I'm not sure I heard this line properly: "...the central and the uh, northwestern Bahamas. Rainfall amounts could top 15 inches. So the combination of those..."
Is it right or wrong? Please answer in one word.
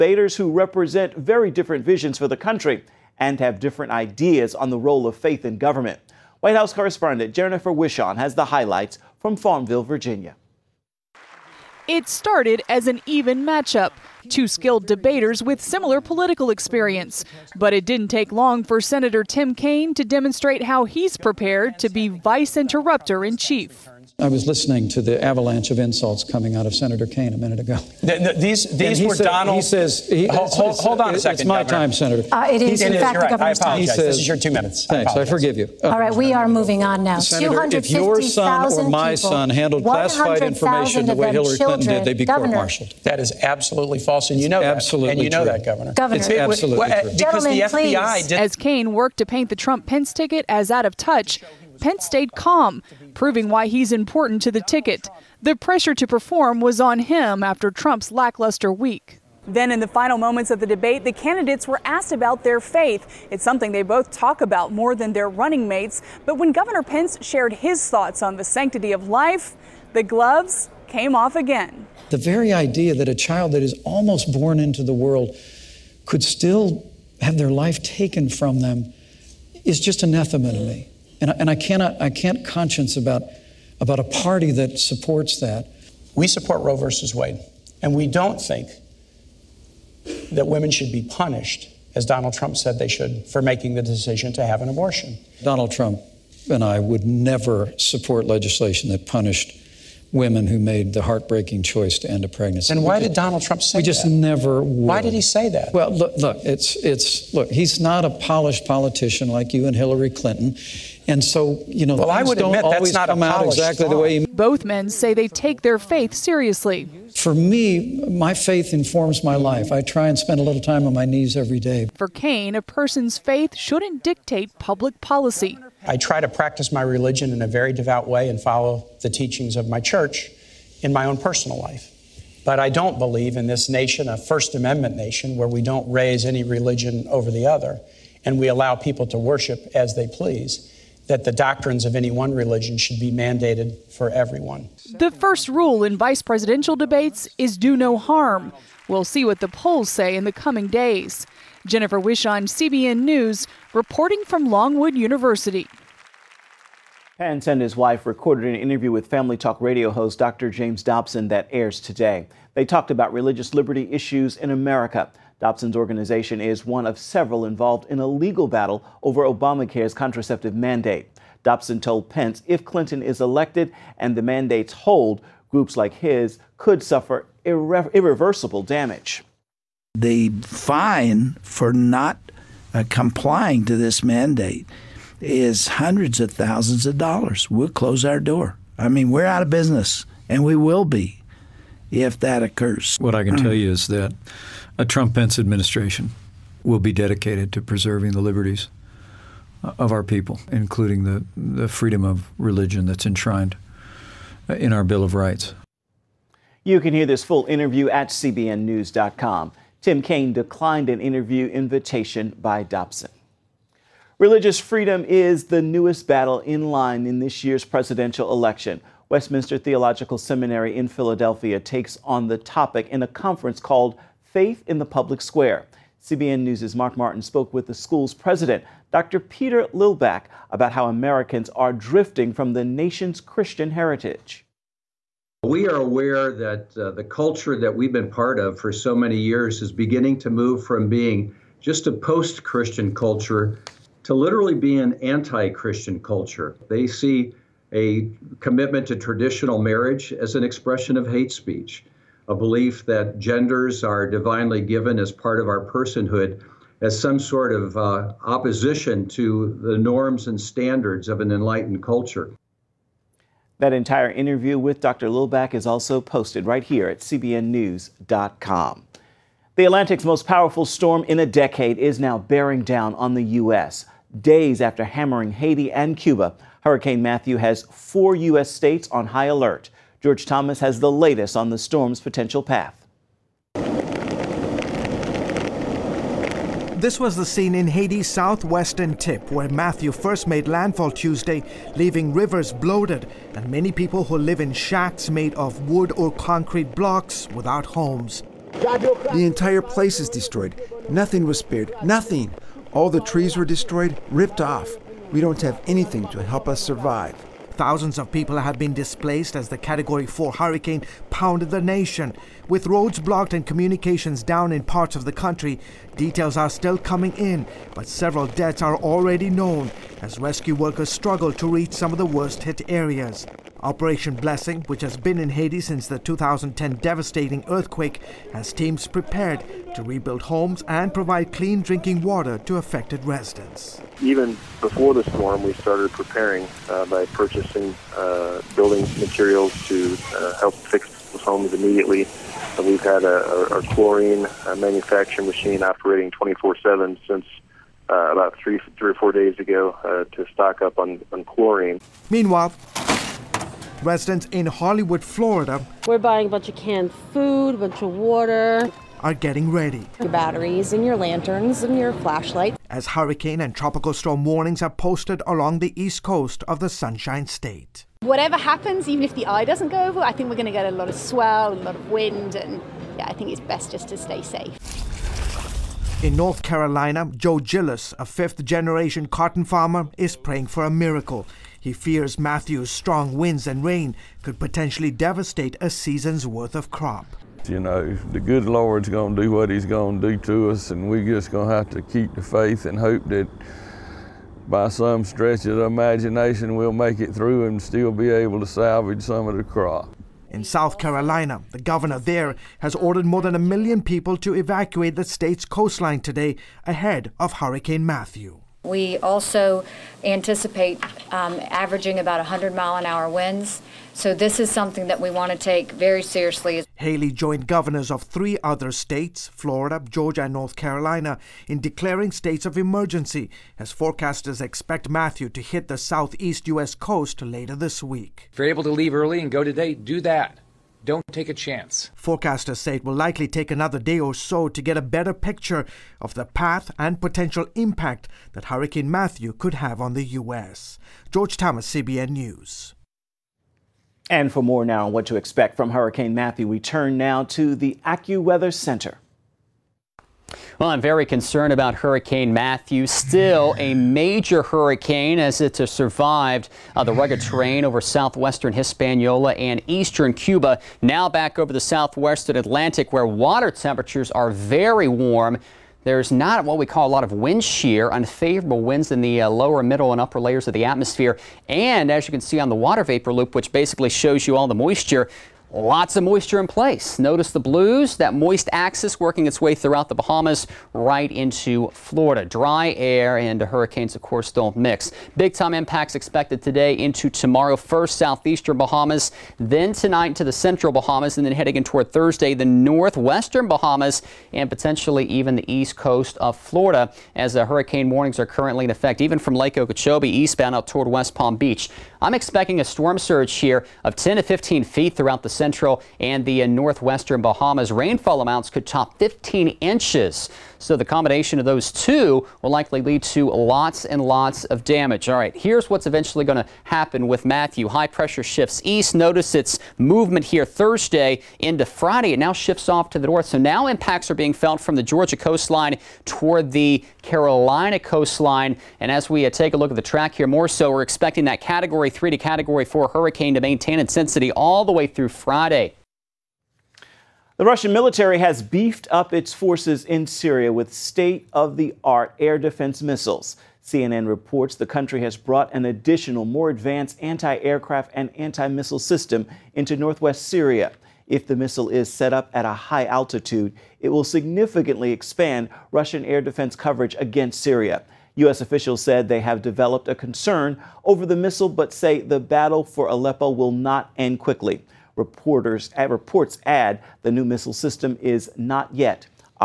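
right.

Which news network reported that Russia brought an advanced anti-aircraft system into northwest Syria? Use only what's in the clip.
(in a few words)
CNN.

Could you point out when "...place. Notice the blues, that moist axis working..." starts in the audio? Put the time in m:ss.
7:56.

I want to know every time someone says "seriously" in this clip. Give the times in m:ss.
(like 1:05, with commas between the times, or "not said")
1:56, 6:56.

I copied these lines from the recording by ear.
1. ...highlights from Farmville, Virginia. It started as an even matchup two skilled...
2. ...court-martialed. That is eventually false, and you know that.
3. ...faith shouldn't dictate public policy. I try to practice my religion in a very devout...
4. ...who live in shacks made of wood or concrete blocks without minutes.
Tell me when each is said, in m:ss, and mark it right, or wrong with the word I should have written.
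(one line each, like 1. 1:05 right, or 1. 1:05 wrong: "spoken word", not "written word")
1. 0:08 right
2. 0:42 wrong: "absolutely", not "eventually"
3. 2:03 right
4. 4:54 wrong: "homes", not "minutes".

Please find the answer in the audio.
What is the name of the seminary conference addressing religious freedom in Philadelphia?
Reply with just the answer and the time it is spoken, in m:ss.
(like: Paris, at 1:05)
Faith in the Public Square, at 3:44.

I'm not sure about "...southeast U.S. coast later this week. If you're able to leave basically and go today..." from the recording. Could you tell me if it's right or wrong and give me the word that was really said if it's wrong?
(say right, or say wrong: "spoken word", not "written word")
wrong: "early", not "basically".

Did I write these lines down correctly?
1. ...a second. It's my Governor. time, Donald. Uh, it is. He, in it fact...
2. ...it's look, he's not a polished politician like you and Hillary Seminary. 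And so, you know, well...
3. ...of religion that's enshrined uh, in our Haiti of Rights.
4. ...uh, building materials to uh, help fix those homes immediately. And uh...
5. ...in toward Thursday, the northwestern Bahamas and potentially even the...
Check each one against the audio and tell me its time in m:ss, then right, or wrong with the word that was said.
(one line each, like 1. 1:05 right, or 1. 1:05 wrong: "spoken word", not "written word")
1. 0:31 wrong: "Senator", not "Donald"
2. 1:46 wrong: "Clinton", not "Seminary"
3. 3:22 wrong: "Bill", not "Haiti"
4. 5:37 right
5. 8:11 right.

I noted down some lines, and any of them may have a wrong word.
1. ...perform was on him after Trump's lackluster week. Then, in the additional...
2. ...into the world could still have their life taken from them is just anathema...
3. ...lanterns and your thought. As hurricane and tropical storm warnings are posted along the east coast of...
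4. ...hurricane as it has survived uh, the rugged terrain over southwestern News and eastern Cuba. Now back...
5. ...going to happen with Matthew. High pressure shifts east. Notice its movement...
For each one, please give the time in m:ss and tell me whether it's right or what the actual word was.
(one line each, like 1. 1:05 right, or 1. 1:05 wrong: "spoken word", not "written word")
1. 0:56 wrong: "final", not "additional"
2. 1:14 right
3. 6:00 wrong: "flashlight", not "thought"
4. 7:34 wrong: "Hispaniola", not "News"
5. 8:36 right.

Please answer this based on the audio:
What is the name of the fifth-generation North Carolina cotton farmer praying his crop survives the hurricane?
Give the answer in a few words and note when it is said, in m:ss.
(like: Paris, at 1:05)
Joe Gillis, at 6:17.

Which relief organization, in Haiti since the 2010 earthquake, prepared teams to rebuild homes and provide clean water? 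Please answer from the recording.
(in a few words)
Operation Blessing.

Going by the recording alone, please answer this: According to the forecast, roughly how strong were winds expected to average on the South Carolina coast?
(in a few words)
100 mph.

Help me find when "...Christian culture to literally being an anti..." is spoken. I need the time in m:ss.
4:02.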